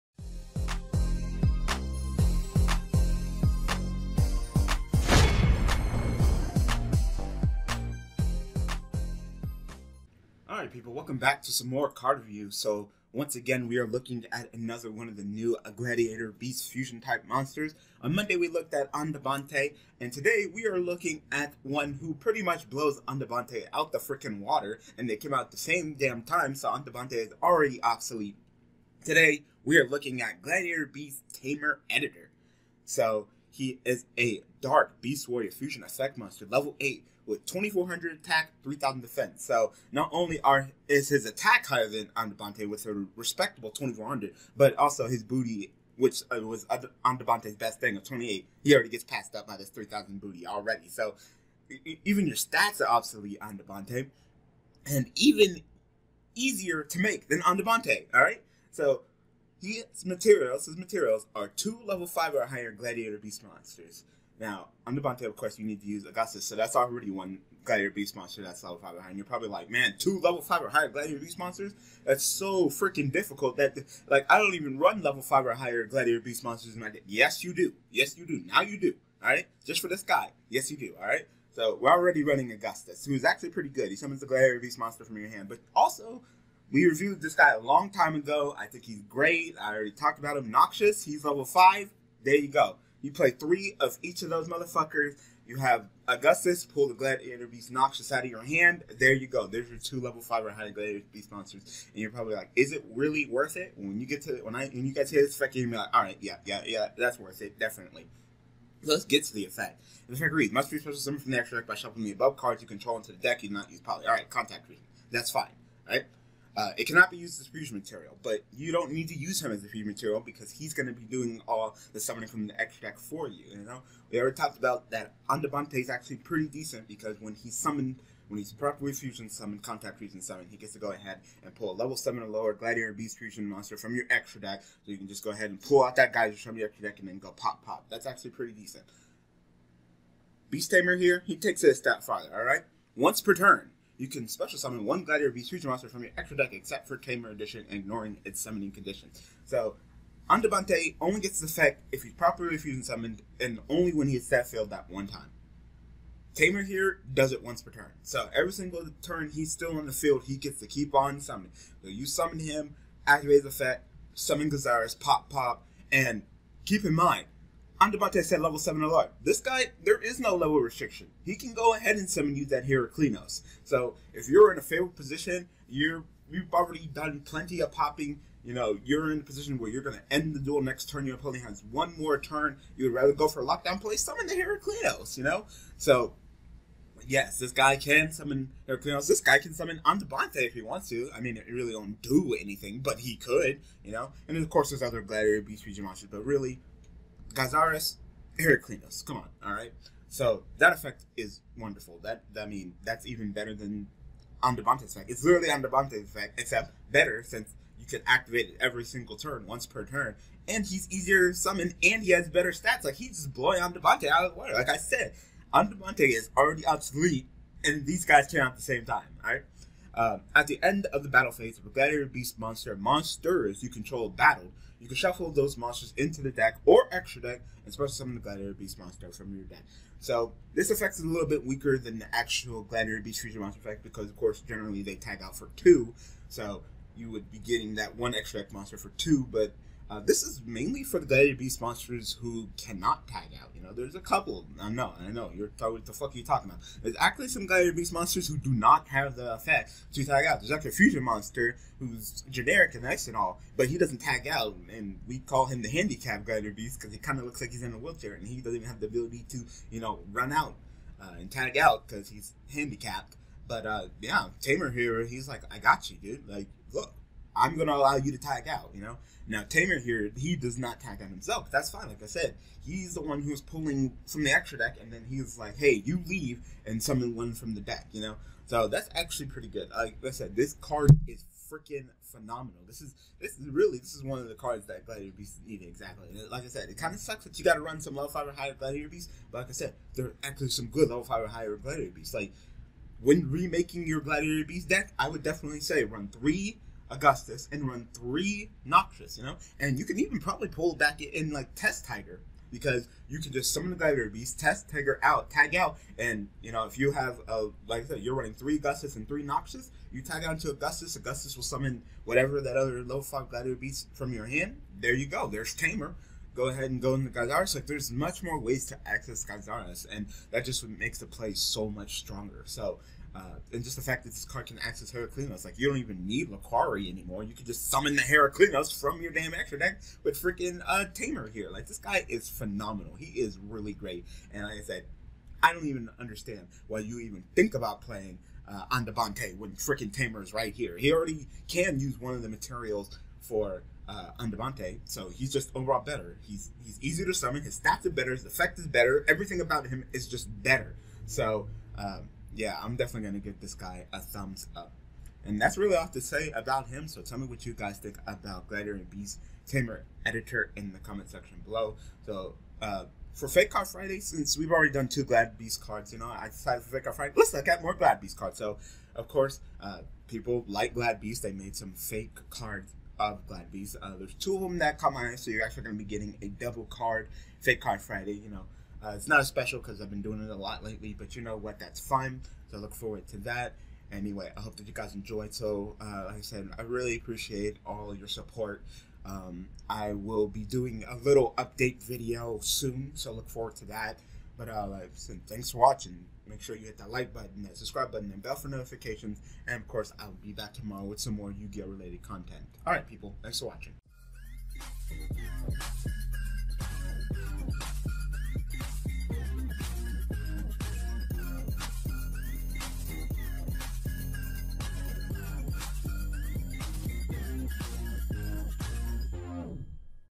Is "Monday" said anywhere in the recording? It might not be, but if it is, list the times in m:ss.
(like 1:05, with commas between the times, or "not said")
0:18.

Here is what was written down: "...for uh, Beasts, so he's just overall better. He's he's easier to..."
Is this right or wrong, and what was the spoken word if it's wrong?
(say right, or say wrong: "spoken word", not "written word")
wrong: "Andavante", not "Beasts".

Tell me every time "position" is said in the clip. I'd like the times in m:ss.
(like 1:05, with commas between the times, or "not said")
2:54, 2:59.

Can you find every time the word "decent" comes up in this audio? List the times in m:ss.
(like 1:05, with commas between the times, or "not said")
2:06, 2:18.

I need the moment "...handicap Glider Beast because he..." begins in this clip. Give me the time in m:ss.
4:15.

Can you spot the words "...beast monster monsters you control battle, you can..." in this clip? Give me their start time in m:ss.
3:42.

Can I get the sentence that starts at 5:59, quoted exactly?
Tamer editor in the comment section below.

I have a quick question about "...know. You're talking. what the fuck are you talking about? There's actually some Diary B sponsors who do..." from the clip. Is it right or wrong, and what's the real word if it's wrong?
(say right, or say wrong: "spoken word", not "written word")
right.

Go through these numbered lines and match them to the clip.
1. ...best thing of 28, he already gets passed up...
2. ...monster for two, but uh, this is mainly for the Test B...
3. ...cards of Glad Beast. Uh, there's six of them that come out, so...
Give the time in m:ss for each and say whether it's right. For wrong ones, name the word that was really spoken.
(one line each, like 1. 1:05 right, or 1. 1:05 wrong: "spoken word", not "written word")
1. 0:47 right
2. 3:58 wrong: "Diary", not "Test"
3. 6:12 wrong: "two", not "six".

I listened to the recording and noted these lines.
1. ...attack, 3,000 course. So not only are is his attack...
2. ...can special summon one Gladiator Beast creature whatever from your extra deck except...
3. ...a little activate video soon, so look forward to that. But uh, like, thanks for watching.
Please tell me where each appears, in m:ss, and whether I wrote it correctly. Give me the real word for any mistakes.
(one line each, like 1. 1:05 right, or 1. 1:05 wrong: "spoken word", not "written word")
1. 0:38 wrong: "defense", not "course"
2. 2:24 wrong: "monster", not "whatever"
3. 6:30 wrong: "update", not "activate".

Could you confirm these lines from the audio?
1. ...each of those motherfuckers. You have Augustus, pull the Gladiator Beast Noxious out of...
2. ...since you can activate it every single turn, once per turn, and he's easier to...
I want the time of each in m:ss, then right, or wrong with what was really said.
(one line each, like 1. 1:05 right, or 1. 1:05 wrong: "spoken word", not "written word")
1. 1:34 right
2. 3:27 right.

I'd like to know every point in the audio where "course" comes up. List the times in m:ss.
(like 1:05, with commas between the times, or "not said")
1:05, 3:14, 3:54, 6:09, 6:39.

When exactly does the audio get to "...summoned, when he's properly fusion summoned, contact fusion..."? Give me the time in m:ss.
2:07.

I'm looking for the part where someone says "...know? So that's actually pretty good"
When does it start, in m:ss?
4:38.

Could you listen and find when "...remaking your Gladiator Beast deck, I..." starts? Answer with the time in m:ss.
4:53.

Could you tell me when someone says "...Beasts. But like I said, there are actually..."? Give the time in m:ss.
4:48.